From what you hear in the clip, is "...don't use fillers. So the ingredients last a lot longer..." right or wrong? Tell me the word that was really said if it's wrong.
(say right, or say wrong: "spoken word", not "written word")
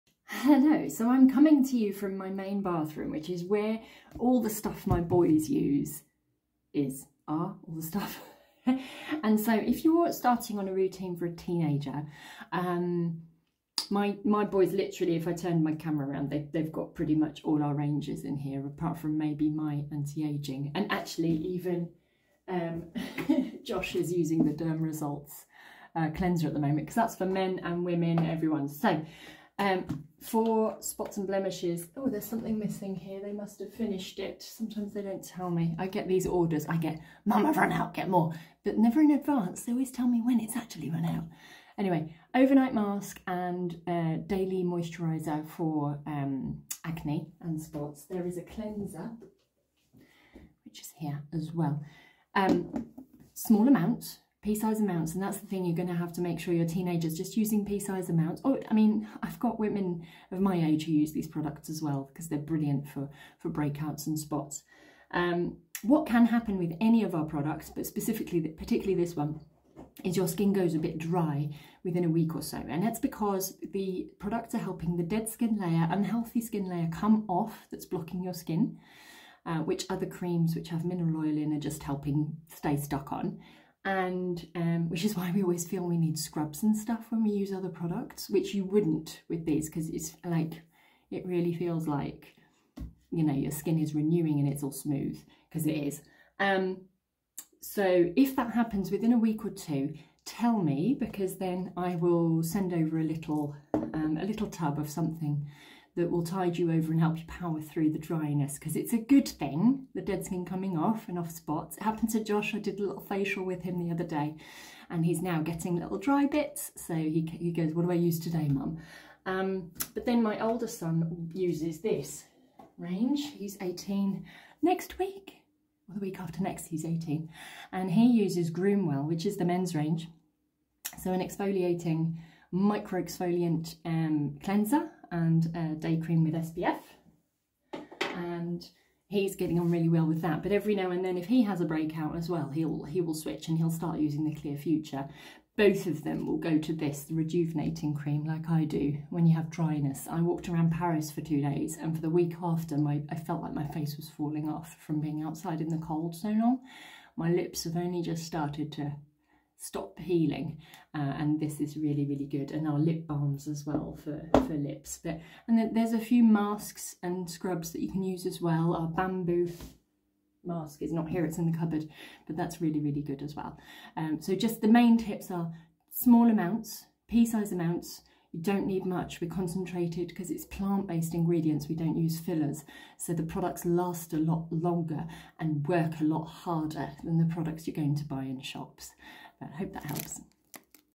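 wrong: "products", not "ingredients".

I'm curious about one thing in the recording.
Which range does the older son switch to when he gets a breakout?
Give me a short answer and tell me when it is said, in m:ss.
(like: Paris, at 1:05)
Clear Future, at 2:24.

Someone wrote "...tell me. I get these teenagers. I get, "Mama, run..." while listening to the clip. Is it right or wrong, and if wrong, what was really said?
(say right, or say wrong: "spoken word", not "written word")
wrong: "orders", not "teenagers".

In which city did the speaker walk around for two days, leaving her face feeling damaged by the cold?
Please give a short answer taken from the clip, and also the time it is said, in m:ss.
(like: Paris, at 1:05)
Paris, at 2:30.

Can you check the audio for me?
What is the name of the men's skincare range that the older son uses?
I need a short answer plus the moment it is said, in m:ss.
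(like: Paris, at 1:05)
Groomwell, at 2:08.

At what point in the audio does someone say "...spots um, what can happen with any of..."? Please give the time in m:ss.
1:04.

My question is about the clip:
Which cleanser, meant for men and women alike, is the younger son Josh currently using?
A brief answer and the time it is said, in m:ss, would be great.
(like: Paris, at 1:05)
Derm Results, at 0:24.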